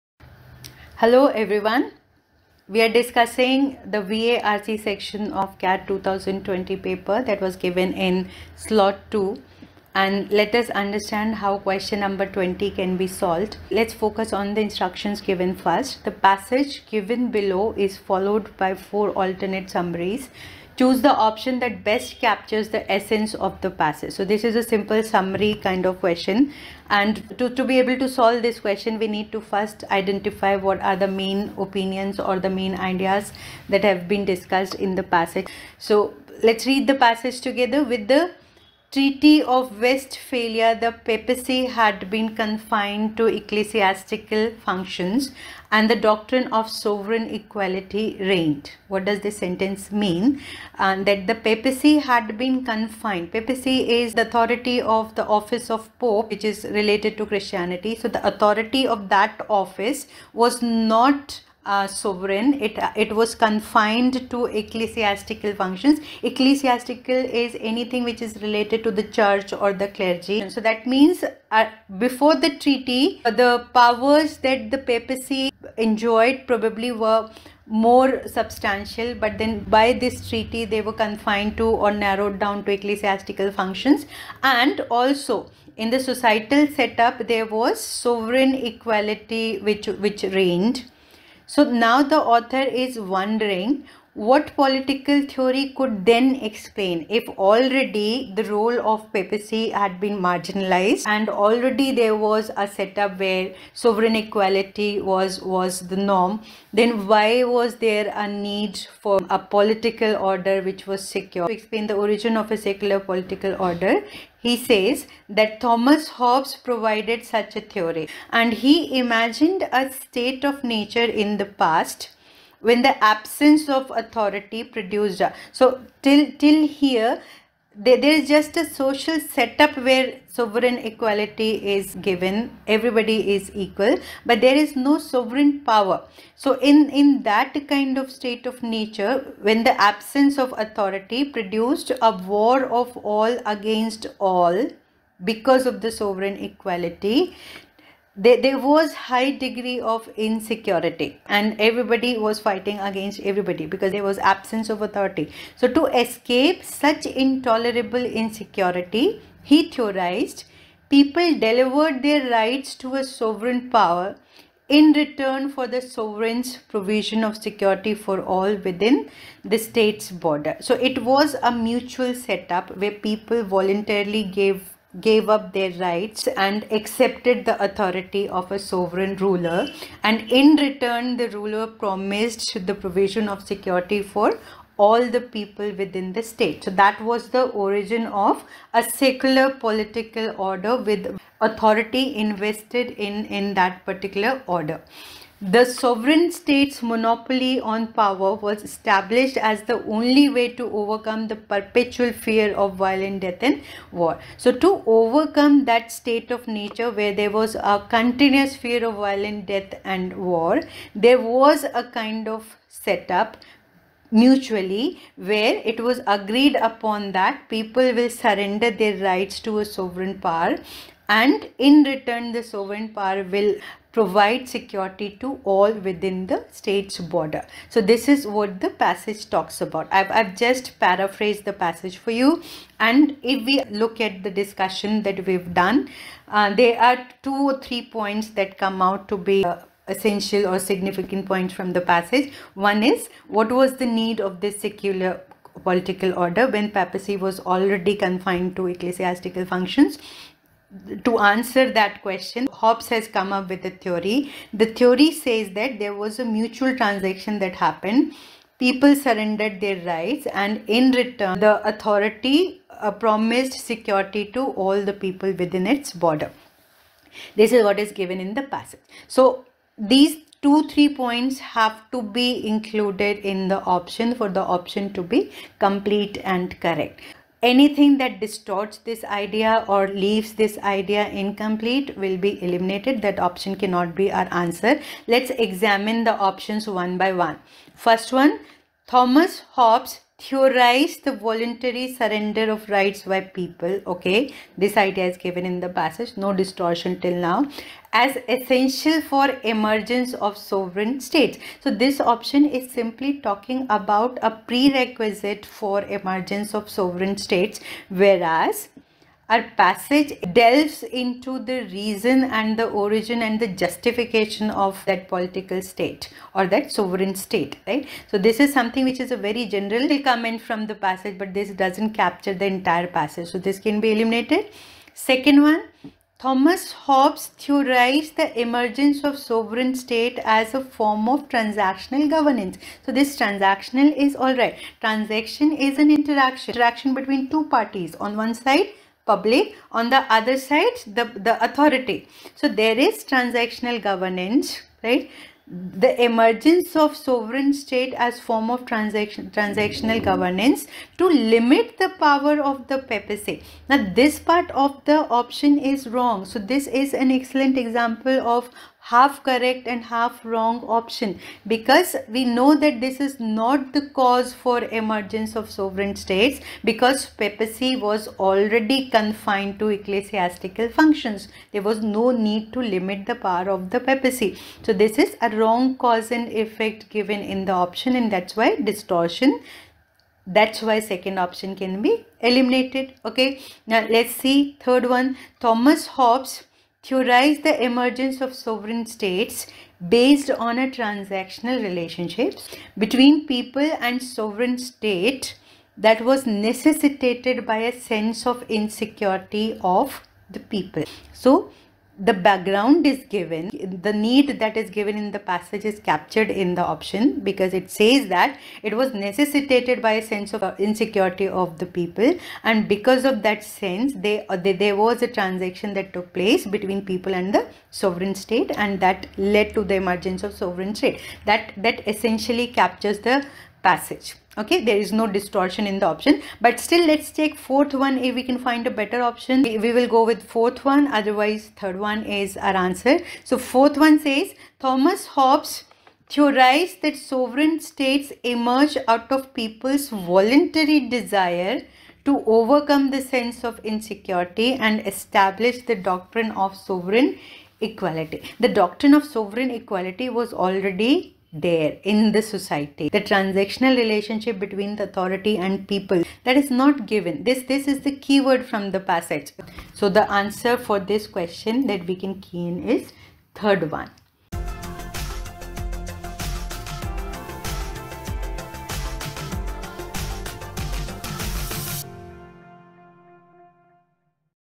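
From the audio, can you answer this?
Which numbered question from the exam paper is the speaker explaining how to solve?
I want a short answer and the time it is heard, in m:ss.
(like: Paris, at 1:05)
20, at 0:11.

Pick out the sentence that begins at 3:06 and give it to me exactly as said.
So that was the origin of a secular political order with authority invested in, in that particular order.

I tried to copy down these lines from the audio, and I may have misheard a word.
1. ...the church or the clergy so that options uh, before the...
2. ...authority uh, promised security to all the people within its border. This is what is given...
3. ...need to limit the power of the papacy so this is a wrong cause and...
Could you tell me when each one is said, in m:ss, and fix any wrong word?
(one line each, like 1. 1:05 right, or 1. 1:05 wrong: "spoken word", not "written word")
1. 1:08 wrong: "means", not "options"
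2. 4:21 right
3. 6:12 right.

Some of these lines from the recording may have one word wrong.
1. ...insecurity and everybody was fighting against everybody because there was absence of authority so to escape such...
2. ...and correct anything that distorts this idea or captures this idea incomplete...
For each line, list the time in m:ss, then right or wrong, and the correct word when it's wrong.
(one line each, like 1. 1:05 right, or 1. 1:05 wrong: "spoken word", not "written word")
1. 2:30 right
2. 4:36 wrong: "leaves", not "captures".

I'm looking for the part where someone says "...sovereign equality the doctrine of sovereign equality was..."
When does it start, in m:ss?
7:26.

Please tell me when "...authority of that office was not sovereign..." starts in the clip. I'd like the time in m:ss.
0:58.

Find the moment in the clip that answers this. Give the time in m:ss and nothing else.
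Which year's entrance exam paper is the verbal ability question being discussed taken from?
0:05.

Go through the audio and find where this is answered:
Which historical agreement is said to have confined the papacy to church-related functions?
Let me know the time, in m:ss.
0:38.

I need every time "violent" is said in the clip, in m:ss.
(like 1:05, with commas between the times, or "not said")
3:22, 3:28.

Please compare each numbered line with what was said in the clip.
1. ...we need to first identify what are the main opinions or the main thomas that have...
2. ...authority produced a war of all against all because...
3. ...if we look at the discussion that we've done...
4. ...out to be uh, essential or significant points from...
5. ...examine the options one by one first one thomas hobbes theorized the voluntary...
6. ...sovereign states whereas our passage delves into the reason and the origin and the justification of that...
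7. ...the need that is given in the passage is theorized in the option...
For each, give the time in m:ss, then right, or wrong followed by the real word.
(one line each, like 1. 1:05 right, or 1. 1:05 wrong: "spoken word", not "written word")
1. 0:28 wrong: "ideas", not "thomas"
2. 2:20 right
3. 3:53 right
4. 3:58 right
5. 4:45 right
6. 5:06 right
7. 6:43 wrong: "captured", not "theorized".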